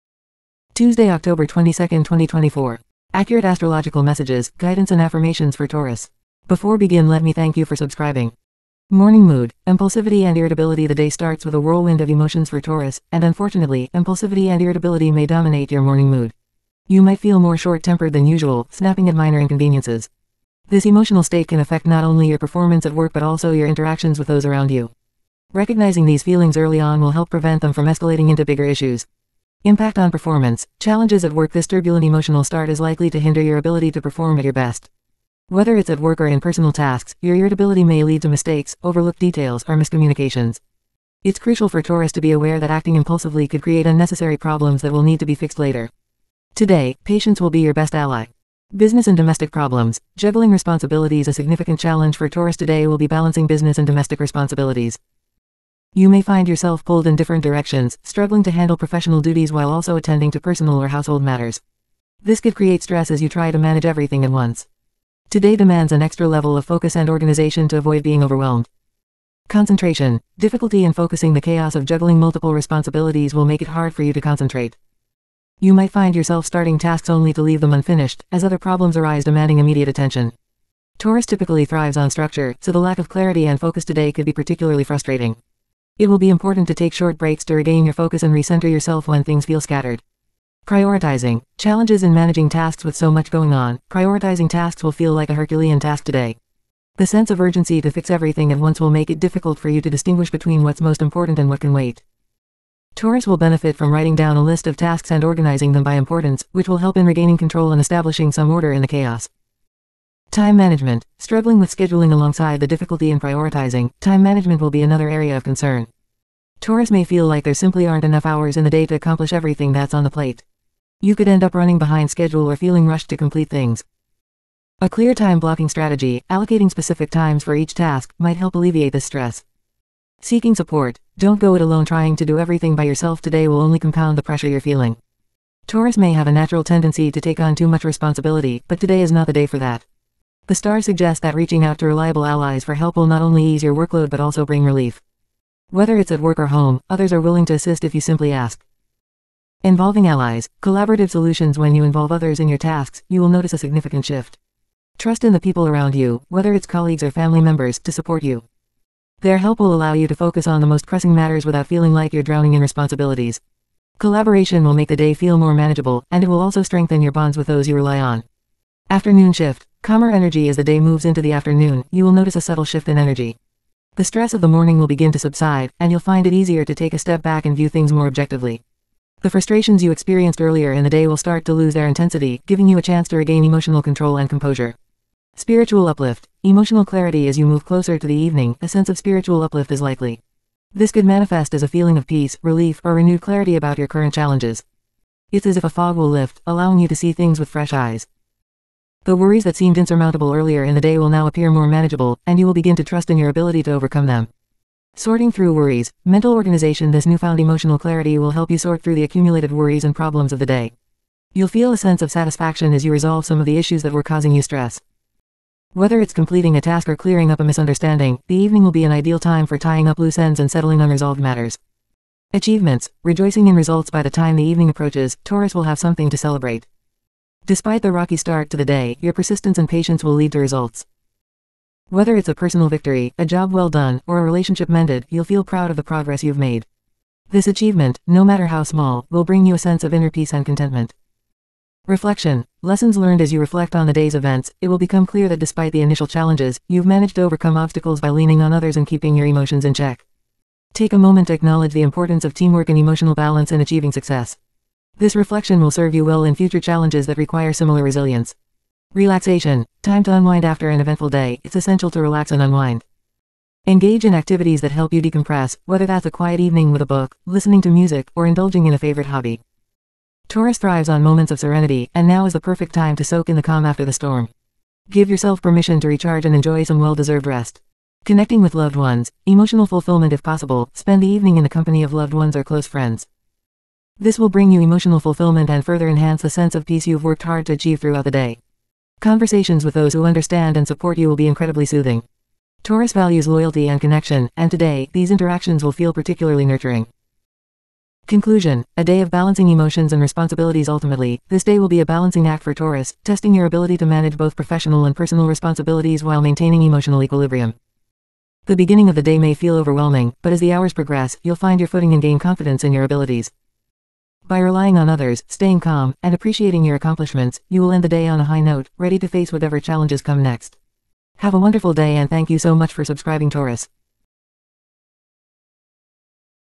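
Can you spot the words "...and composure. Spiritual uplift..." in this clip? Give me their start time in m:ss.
3:04.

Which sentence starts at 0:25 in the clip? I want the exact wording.
Recognizing these feelings early on will help prevent them from escalating into bigger issues.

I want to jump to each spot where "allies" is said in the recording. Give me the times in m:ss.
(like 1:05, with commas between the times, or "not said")
2:22, 2:30.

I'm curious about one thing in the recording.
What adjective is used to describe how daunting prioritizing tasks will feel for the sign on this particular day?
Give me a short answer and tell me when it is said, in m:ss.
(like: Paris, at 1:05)
Herculean, at 1:35.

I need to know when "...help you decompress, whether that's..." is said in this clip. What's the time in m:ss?
4:24.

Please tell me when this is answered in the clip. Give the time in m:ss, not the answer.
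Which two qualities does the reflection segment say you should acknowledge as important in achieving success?
4:12.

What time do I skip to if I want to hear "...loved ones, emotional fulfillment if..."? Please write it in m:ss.
4:38.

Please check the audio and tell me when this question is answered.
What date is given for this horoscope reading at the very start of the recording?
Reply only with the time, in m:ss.
0:01.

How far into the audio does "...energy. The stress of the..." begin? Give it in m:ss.
2:52.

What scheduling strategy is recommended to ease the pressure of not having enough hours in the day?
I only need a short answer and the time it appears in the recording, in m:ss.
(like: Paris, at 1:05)
Time blocking, at 2:05.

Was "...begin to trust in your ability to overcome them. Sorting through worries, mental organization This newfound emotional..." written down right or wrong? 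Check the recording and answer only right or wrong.
right.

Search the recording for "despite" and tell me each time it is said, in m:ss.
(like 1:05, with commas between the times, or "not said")
3:47, 4:05.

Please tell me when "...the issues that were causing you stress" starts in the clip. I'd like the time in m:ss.
3:33.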